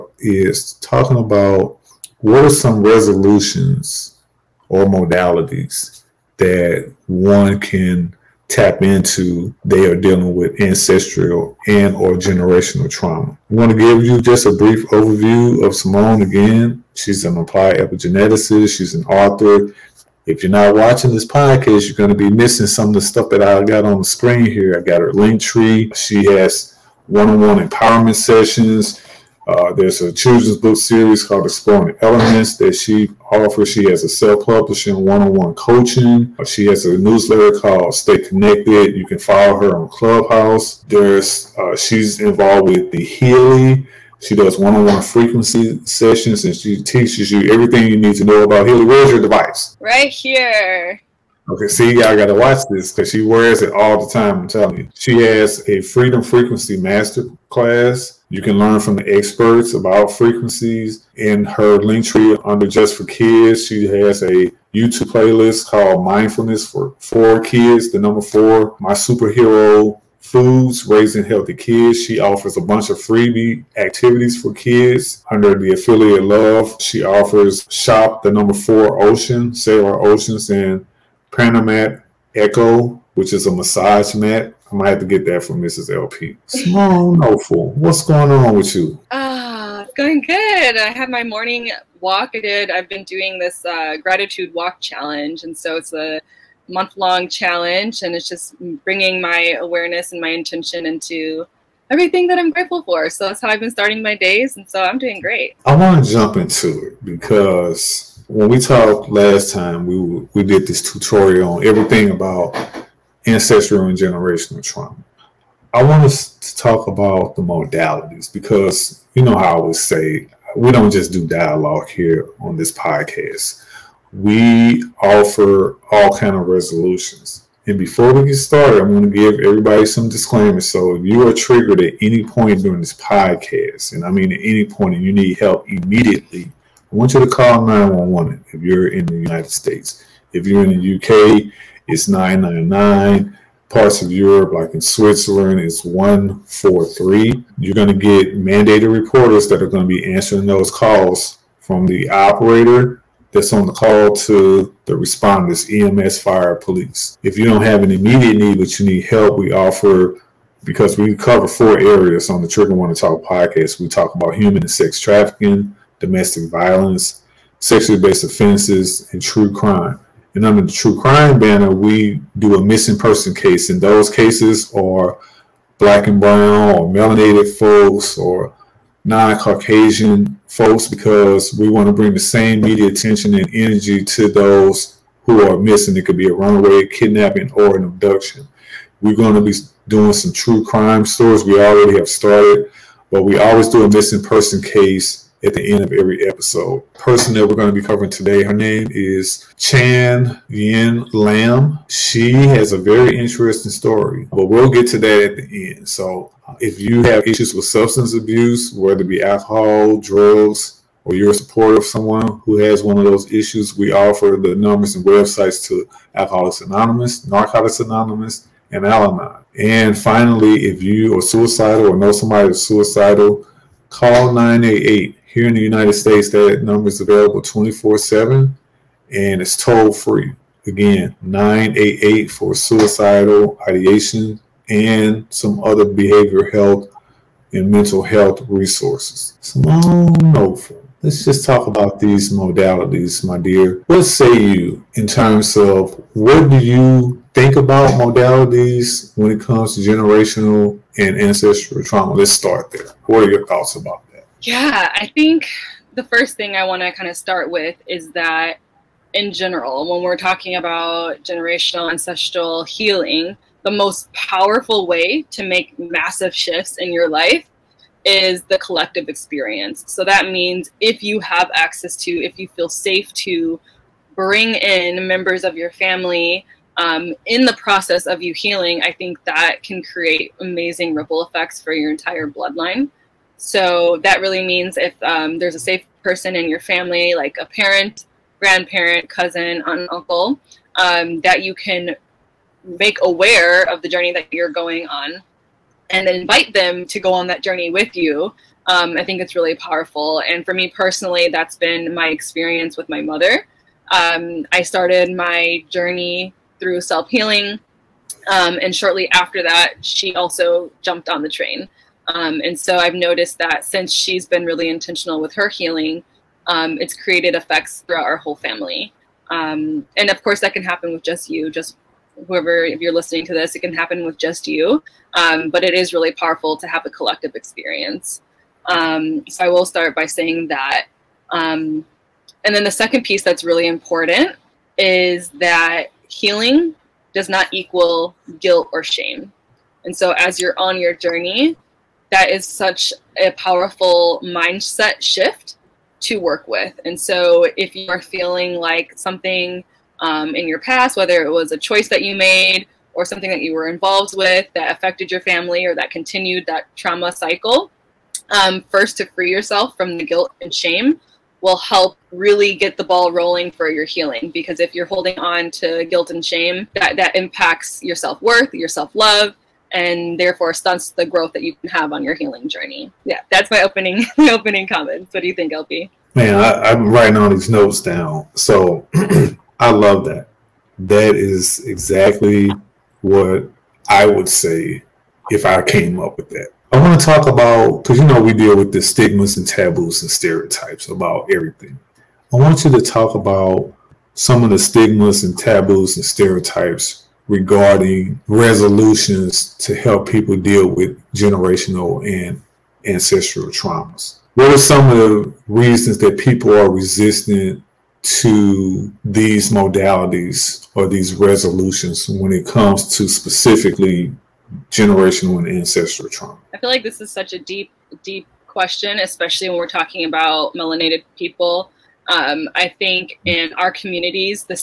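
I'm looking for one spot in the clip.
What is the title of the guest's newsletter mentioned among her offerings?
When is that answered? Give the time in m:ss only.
0:37.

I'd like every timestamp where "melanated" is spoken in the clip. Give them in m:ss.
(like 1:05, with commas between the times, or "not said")
2:56, 7:00.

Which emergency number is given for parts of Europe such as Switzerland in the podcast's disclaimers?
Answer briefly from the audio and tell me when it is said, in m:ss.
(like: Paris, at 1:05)
143, at 2:25.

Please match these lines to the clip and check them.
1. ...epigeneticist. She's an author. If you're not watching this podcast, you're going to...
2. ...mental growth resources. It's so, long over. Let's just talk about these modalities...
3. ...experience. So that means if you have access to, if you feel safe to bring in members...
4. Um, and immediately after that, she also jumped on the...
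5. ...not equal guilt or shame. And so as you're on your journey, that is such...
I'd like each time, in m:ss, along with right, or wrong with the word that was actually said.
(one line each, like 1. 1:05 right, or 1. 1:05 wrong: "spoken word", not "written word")
1. 0:17 right
2. 3:57 wrong: "health", not "growth"
3. 4:29 right
4. 5:08 wrong: "shortly", not "immediately"
5. 5:37 right.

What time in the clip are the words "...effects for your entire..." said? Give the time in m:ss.
4:41.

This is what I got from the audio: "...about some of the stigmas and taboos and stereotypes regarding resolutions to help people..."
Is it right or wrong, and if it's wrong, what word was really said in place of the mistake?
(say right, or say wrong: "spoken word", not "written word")
right.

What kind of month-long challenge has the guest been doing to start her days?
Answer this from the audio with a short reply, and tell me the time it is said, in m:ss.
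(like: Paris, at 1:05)
gratitude walk challenge, at 1:33.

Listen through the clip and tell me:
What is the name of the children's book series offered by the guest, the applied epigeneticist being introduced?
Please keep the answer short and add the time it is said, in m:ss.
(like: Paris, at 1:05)
Exploring Elements, at 0:31.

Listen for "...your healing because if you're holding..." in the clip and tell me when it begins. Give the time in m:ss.
6:03.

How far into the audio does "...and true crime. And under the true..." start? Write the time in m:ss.
2:49.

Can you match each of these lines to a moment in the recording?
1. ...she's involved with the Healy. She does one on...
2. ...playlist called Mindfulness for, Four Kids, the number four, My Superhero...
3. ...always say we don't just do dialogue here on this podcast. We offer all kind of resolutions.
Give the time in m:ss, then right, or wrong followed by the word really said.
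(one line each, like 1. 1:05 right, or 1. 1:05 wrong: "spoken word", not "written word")
1. 0:41 right
2. 1:05 right
3. 1:59 right.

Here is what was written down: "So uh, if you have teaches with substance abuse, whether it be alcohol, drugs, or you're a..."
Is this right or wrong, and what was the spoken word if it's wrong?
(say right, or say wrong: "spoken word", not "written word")
wrong: "issues", not "teaches".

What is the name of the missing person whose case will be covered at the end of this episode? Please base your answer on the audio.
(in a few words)
Chan Yin Lam.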